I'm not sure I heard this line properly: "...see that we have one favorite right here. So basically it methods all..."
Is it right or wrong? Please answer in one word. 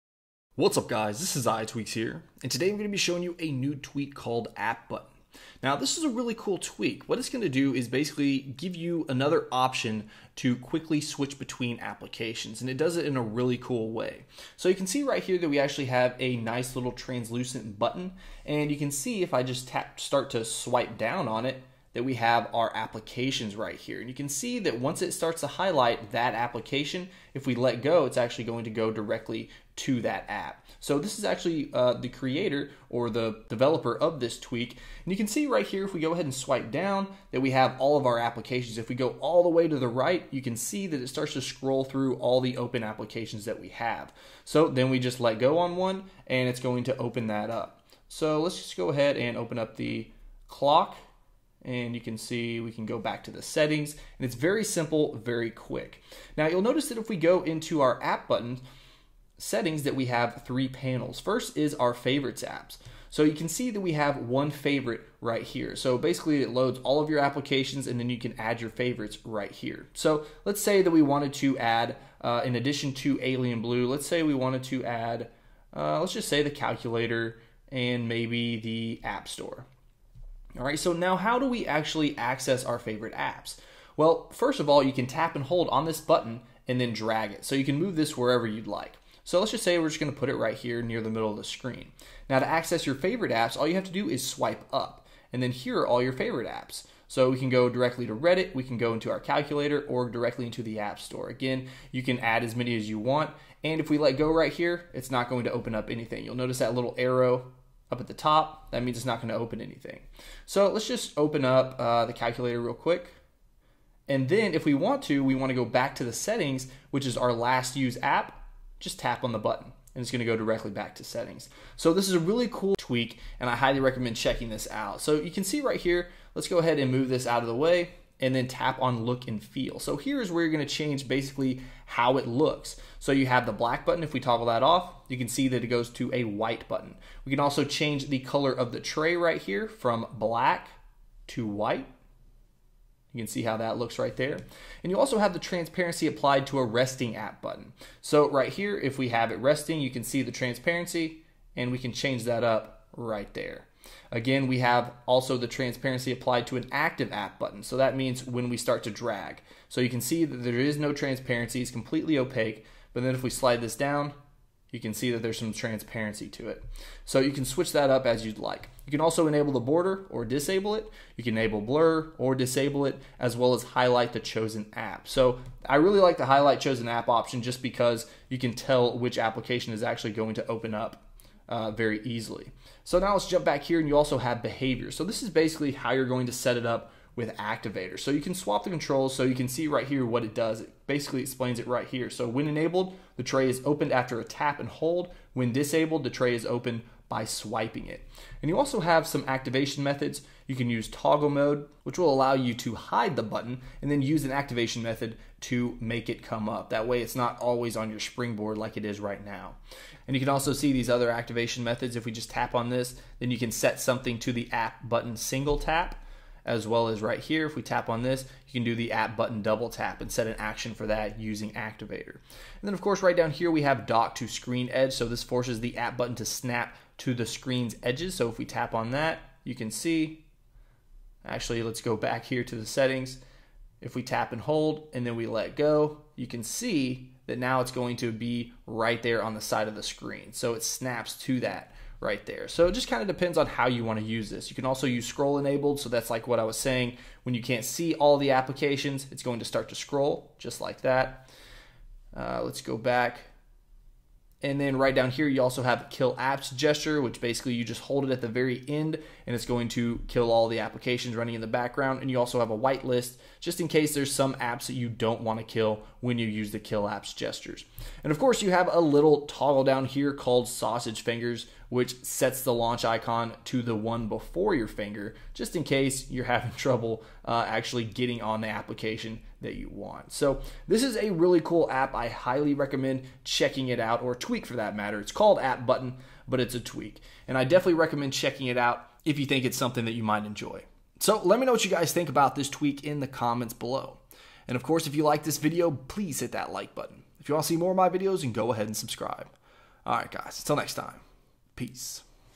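wrong.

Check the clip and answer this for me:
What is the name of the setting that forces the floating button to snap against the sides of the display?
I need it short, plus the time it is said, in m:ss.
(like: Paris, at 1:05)
Dock to screen edge, at 3:43.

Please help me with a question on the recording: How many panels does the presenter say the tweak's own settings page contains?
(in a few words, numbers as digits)
3.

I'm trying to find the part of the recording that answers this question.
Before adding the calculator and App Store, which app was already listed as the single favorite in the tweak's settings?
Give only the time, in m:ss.
1:13.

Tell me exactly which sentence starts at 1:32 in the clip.
Now to access your favorite apps, all you have to do is swipe up.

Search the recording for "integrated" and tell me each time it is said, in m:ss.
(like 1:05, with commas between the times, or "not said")
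not said.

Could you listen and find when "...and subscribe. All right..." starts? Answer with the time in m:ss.
4:58.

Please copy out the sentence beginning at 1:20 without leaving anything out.
All right, so now how do we actually access our favorite apps?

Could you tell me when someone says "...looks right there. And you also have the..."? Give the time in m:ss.
2:23.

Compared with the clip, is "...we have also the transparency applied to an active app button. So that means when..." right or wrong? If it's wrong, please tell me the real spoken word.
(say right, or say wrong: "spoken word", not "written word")
right.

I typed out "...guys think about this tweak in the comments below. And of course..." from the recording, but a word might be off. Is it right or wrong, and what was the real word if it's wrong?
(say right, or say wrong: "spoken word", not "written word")
right.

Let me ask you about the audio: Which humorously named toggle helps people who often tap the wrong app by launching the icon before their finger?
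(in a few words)
Sausage fingers.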